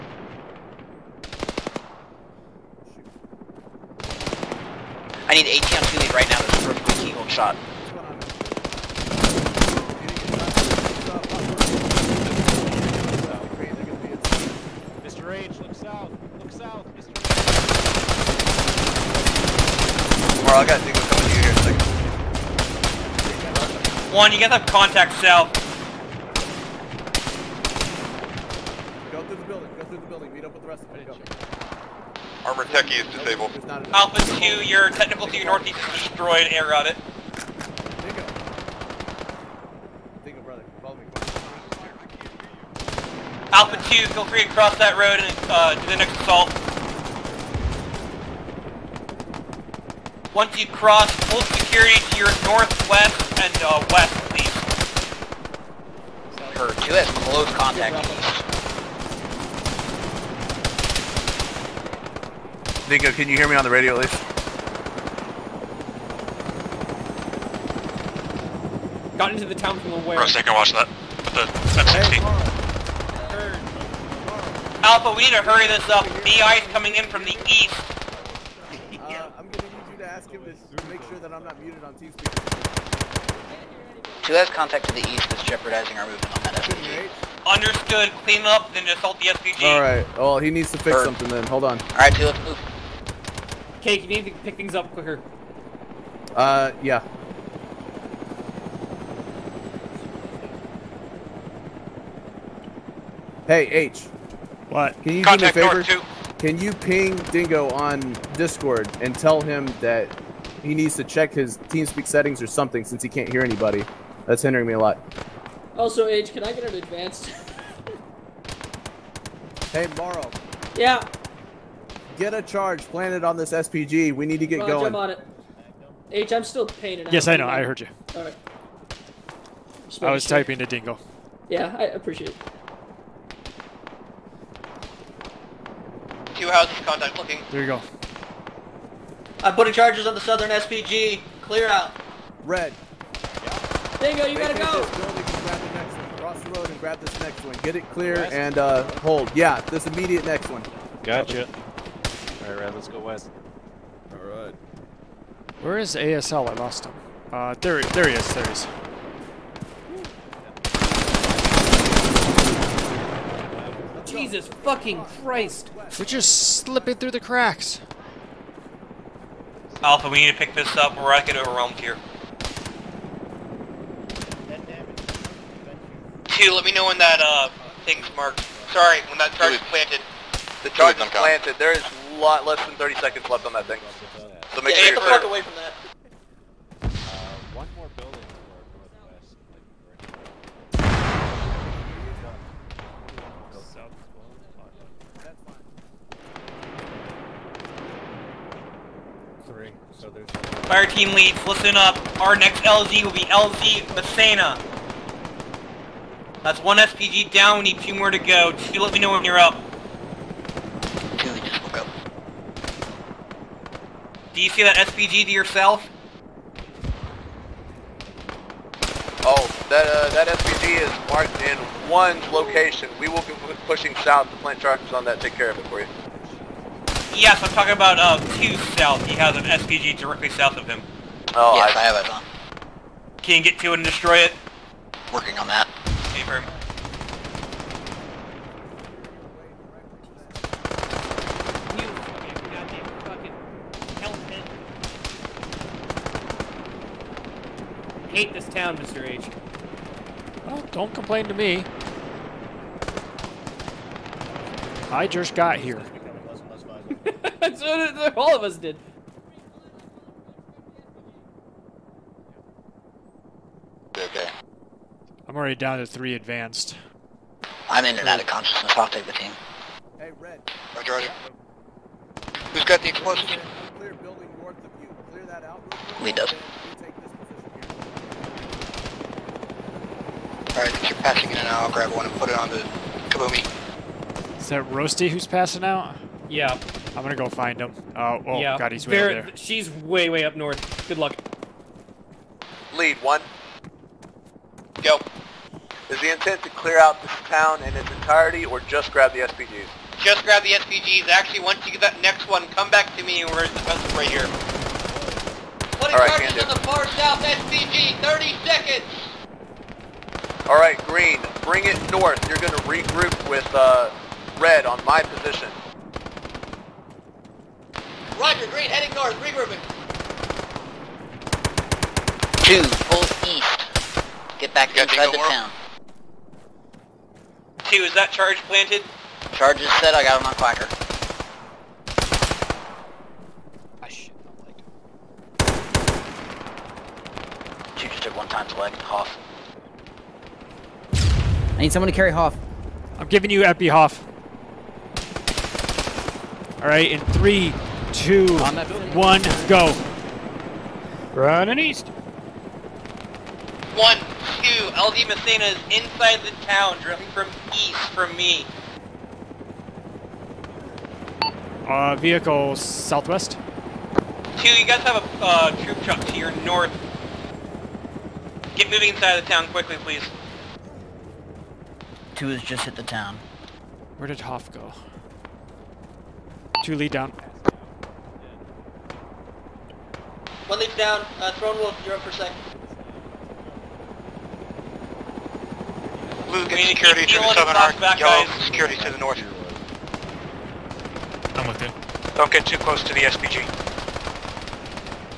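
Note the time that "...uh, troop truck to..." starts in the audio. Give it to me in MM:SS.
06:05.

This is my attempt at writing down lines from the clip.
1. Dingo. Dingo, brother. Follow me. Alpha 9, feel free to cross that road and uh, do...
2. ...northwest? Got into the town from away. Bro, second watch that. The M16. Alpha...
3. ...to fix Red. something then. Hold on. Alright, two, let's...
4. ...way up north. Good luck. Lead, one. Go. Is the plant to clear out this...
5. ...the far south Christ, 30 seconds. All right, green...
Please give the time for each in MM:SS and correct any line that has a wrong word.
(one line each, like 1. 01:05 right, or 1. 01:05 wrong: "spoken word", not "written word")
1. 00:38 wrong: "2", not "9"
2. 01:04 wrong: "least", not "northwest"
3. 01:30 wrong: "Bird", not "Red"
4. 04:50 wrong: "intent", not "plant"
5. 05:06 wrong: "SPG", not "Christ".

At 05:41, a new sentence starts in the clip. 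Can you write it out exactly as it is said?
I need someone to carry Hoff.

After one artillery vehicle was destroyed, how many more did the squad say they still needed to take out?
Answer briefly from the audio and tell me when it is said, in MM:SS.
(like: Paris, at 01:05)
2, at 03:27.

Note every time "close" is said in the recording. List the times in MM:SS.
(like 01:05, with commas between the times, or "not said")
00:57, 06:32.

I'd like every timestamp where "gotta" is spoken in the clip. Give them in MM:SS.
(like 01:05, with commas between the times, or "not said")
00:24, 02:24.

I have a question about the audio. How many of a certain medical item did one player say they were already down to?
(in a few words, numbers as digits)
3.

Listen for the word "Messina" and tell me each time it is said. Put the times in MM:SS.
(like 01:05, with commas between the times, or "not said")
03:23, 05:55.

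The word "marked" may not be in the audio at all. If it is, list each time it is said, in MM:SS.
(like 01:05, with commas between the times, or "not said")
02:58, 03:41.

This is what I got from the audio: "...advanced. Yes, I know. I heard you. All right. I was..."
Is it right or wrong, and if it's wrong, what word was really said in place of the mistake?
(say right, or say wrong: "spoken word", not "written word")
wrong: "painted", not "advanced".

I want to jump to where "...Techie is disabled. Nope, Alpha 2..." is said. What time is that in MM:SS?
00:32.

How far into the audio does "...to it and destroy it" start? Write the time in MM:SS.
03:53.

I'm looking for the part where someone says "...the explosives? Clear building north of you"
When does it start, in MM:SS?
04:32.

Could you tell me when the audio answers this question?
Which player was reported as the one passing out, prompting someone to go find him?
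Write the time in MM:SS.
04:44.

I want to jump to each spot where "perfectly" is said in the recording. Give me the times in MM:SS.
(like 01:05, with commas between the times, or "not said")
not said.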